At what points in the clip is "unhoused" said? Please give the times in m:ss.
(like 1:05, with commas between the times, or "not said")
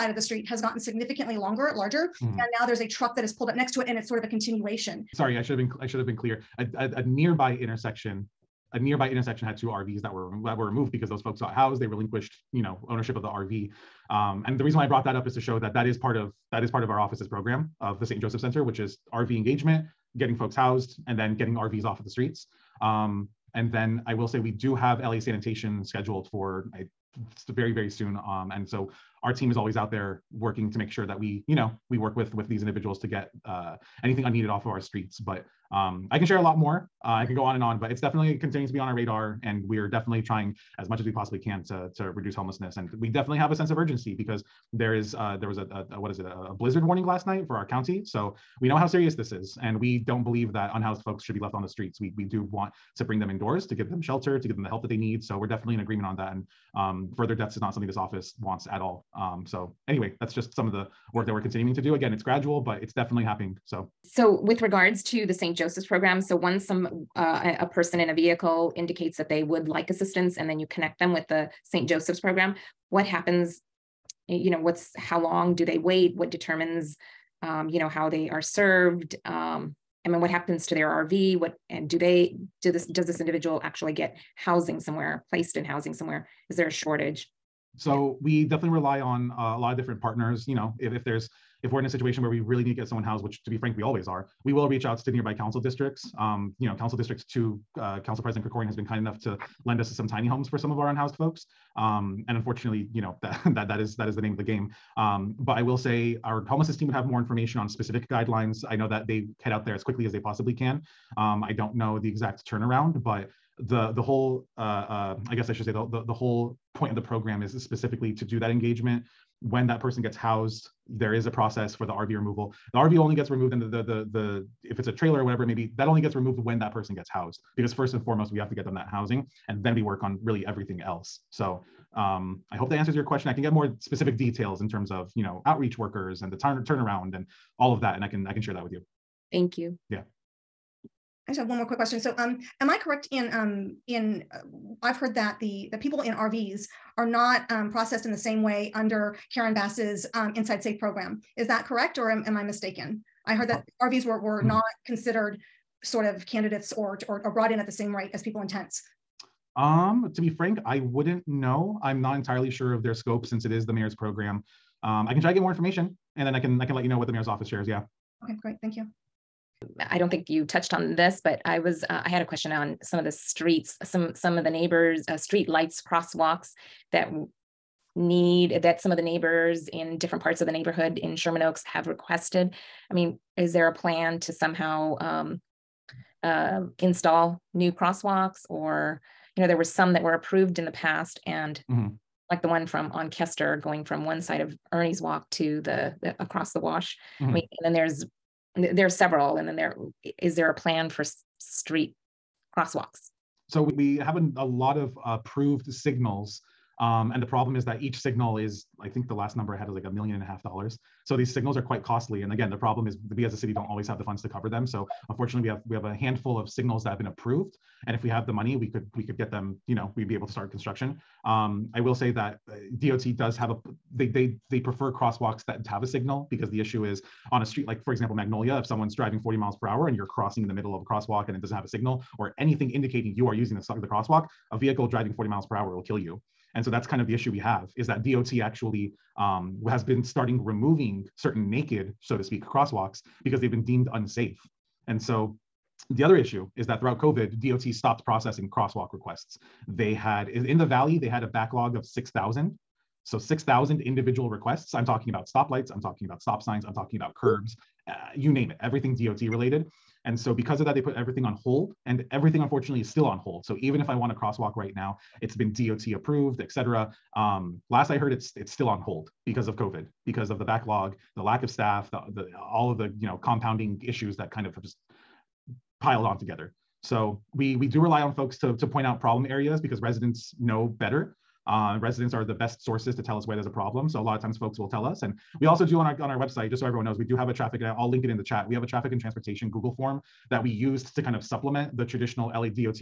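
0:50, 1:40.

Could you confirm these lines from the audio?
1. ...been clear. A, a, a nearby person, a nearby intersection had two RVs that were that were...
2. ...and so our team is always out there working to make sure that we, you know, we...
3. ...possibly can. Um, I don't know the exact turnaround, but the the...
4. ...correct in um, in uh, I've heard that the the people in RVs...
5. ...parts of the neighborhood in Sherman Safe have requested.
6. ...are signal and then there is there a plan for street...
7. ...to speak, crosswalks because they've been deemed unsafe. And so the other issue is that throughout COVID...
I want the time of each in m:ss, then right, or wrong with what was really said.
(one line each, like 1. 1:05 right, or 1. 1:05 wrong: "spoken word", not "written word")
1. 0:06 wrong: "intersection", not "person"
2. 0:28 right
3. 1:50 right
4. 2:22 right
5. 3:00 wrong: "Oaks", not "Safe"
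6. 3:18 wrong: "several", not "signal"
7. 4:02 right.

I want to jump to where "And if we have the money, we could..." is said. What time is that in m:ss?
3:37.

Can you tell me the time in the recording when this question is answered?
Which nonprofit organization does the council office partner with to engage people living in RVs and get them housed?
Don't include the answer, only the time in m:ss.
0:18.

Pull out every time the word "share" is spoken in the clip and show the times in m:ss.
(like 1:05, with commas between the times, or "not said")
0:36, 2:18, 2:47.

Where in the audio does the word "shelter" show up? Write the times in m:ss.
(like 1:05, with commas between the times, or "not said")
0:53.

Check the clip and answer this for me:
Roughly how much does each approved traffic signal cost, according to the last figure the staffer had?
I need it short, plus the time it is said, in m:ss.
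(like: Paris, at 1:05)
$1.5 million, at 3:29.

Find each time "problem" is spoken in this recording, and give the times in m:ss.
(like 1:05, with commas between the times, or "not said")
3:27, 3:32, 4:39, 4:43.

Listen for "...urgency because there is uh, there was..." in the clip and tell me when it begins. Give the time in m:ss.
0:43.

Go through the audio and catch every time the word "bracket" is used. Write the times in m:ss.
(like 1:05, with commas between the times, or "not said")
not said.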